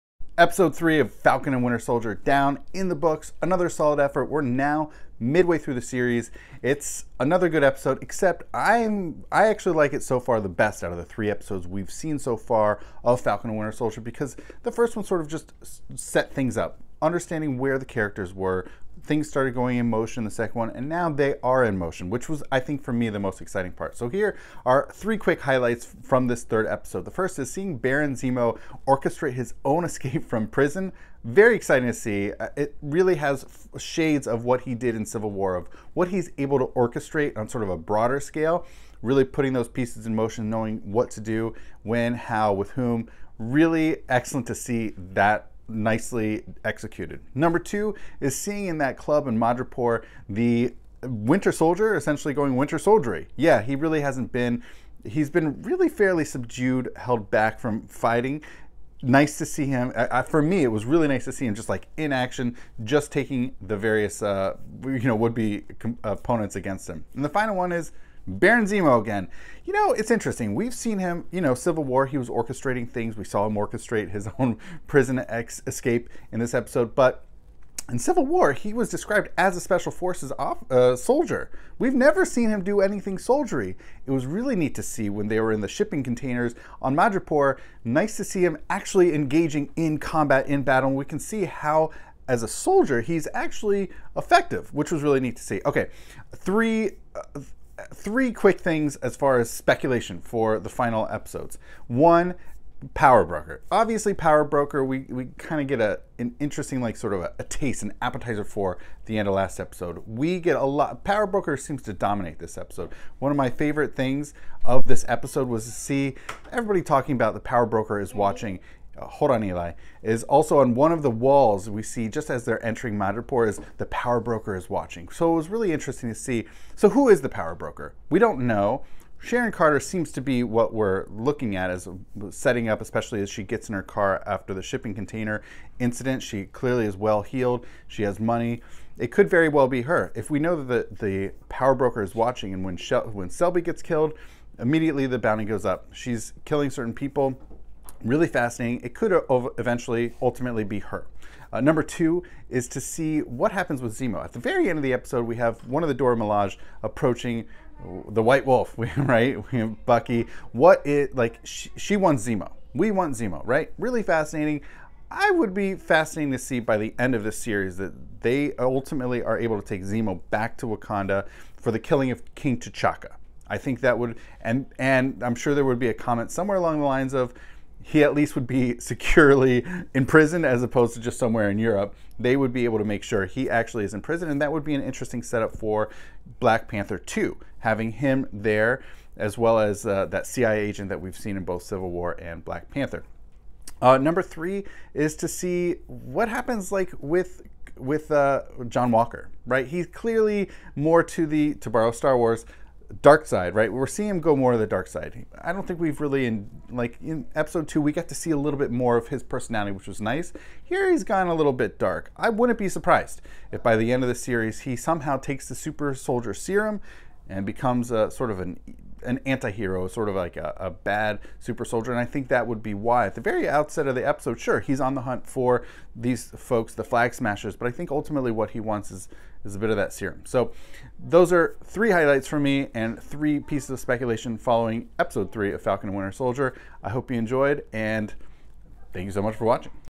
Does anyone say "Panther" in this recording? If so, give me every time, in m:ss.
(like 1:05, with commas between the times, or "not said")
3:06, 3:12.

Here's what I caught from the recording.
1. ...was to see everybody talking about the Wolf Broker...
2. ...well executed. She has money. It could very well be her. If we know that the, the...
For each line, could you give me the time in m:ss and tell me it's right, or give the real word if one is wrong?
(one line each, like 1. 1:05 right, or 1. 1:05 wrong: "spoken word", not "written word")
1. 1:55 wrong: "Power", not "Wolf"
2. 2:16 wrong: "heeled", not "executed".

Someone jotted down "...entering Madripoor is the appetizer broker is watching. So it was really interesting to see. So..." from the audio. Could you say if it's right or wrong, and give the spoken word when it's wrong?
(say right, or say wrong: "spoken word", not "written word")
wrong: "power", not "appetizer".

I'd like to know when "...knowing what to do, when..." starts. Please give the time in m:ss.
0:40.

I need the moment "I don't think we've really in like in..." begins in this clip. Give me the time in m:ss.
3:25.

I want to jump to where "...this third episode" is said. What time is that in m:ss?
0:26.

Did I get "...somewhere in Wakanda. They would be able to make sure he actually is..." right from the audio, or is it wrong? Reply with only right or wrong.
wrong.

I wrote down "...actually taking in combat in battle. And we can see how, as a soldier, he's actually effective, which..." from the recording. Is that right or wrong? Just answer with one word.
wrong.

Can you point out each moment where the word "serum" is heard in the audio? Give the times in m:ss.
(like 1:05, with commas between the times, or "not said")
3:36, 3:49.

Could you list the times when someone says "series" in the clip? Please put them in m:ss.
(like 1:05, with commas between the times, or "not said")
0:05, 2:47, 3:34.